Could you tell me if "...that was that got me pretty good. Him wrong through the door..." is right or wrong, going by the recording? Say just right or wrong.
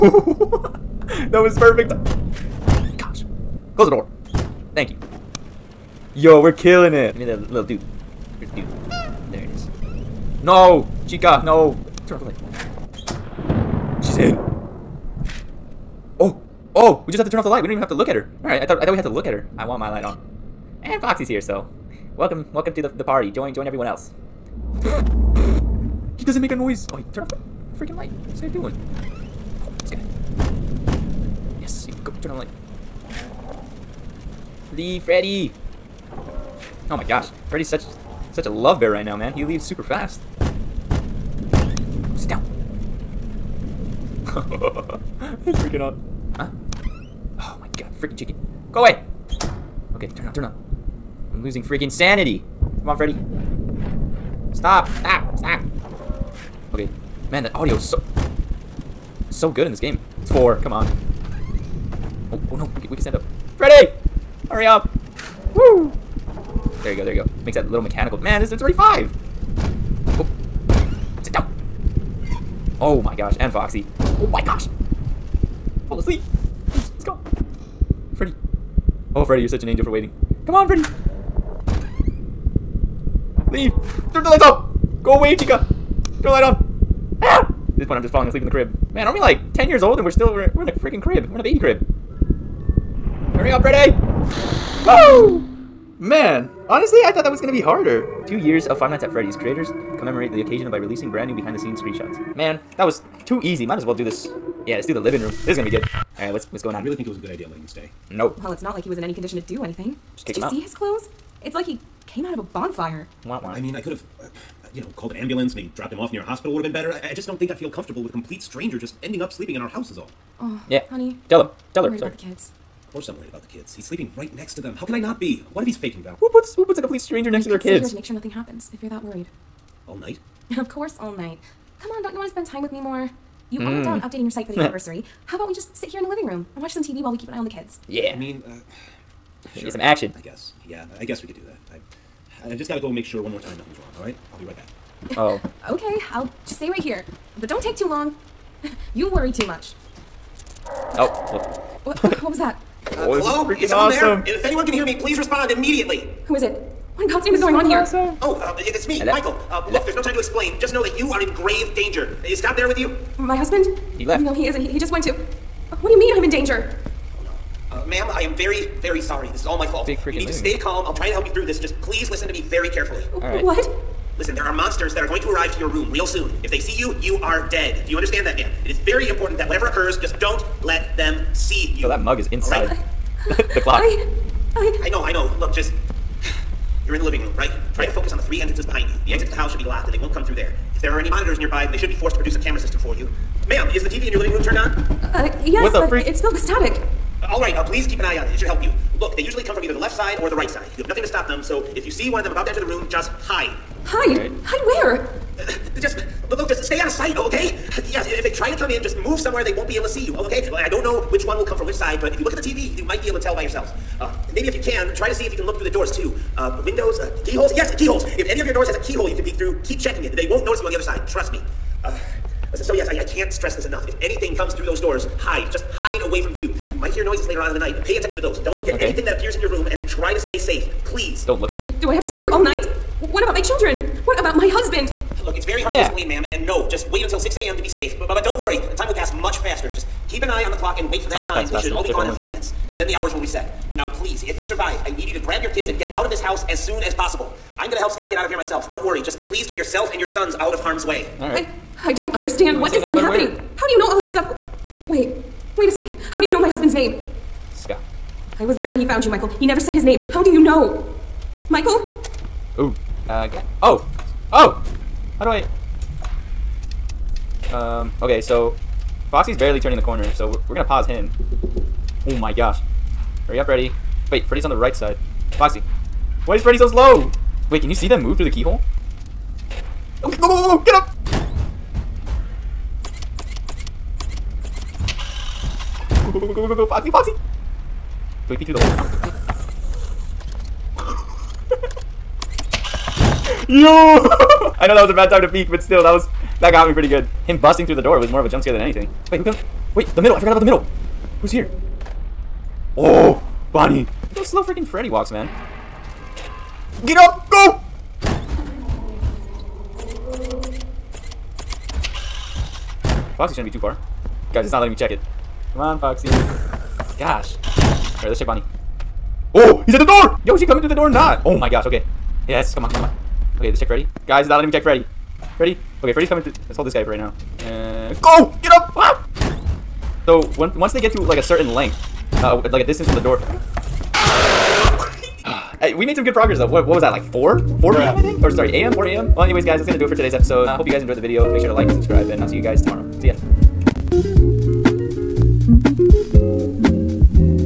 wrong.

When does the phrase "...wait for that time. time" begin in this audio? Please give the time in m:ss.
4:00.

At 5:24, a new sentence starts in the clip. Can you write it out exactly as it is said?
Guys, he's not letting me check Freddy.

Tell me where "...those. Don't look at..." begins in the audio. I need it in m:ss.
3:48.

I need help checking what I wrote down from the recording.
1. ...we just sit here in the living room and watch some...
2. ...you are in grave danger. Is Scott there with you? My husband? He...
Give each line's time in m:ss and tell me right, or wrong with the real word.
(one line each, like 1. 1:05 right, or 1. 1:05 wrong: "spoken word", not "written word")
1. 2:15 right
2. 2:40 right.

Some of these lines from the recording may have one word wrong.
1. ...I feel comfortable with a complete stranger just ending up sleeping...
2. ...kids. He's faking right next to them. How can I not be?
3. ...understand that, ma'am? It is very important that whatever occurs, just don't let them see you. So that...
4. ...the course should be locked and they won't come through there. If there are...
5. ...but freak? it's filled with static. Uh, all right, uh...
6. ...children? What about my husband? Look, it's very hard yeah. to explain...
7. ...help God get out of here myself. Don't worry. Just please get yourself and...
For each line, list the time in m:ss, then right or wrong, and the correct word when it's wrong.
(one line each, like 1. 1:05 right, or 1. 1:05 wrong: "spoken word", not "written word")
1. 1:57 right
2. 2:03 wrong: "sleeping", not "faking"
3. 2:57 right
4. 3:09 wrong: "house", not "course"
5. 3:15 right
6. 3:53 right
7. 4:07 wrong: "Scott", not "God".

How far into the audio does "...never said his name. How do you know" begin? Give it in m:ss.
4:19.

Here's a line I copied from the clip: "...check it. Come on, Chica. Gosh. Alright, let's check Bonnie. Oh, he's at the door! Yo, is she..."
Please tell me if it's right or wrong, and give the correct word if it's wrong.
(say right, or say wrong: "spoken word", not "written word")
wrong: "Foxy", not "Chica".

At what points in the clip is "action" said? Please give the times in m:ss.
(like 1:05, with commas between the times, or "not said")
2:19.